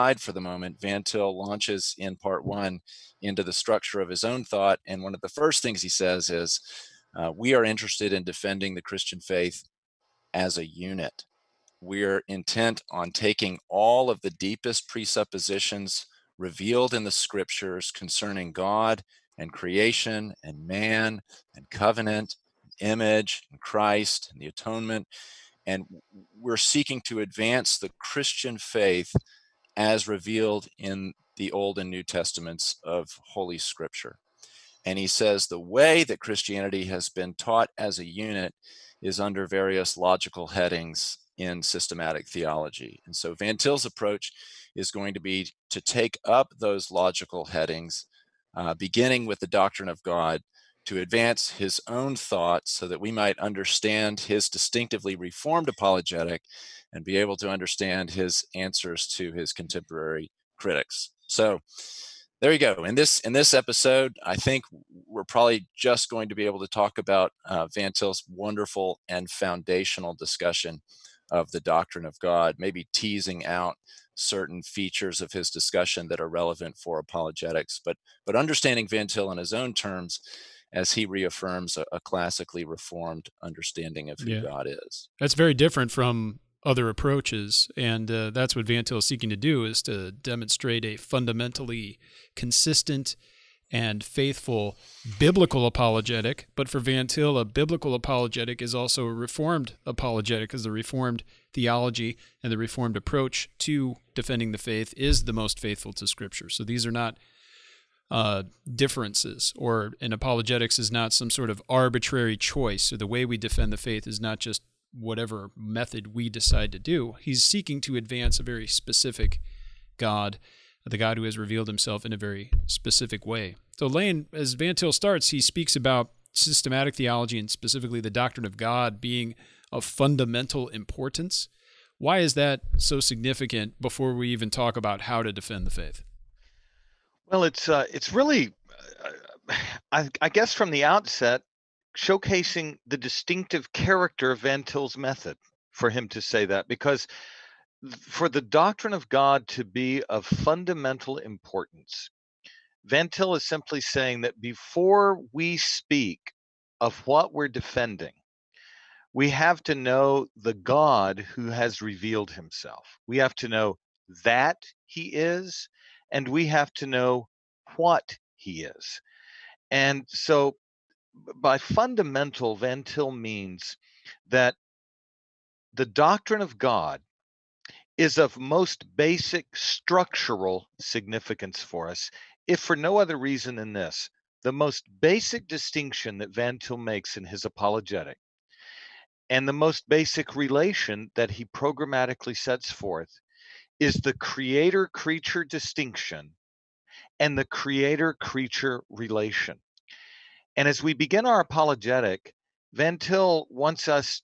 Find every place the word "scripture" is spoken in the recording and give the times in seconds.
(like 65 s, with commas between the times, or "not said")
17 s, 33 s, 106 s.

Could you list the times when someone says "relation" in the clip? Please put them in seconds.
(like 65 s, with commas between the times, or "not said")
190 s, 198 s.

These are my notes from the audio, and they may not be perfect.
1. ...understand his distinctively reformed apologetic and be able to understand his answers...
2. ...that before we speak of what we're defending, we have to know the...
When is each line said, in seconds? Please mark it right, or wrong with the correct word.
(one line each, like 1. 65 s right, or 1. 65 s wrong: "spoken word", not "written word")
1. 53 s right
2. 154 s right.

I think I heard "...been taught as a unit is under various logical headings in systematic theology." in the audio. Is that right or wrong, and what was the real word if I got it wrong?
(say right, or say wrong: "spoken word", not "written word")
right.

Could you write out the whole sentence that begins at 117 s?
He's seeking to advance a very specific God the God who has revealed himself in a very specific way.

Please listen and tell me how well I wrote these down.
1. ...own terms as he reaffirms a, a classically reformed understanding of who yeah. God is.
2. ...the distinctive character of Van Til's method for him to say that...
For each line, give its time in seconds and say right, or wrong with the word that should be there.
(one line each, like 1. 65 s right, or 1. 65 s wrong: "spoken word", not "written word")
1. 79 s right
2. 142 s right.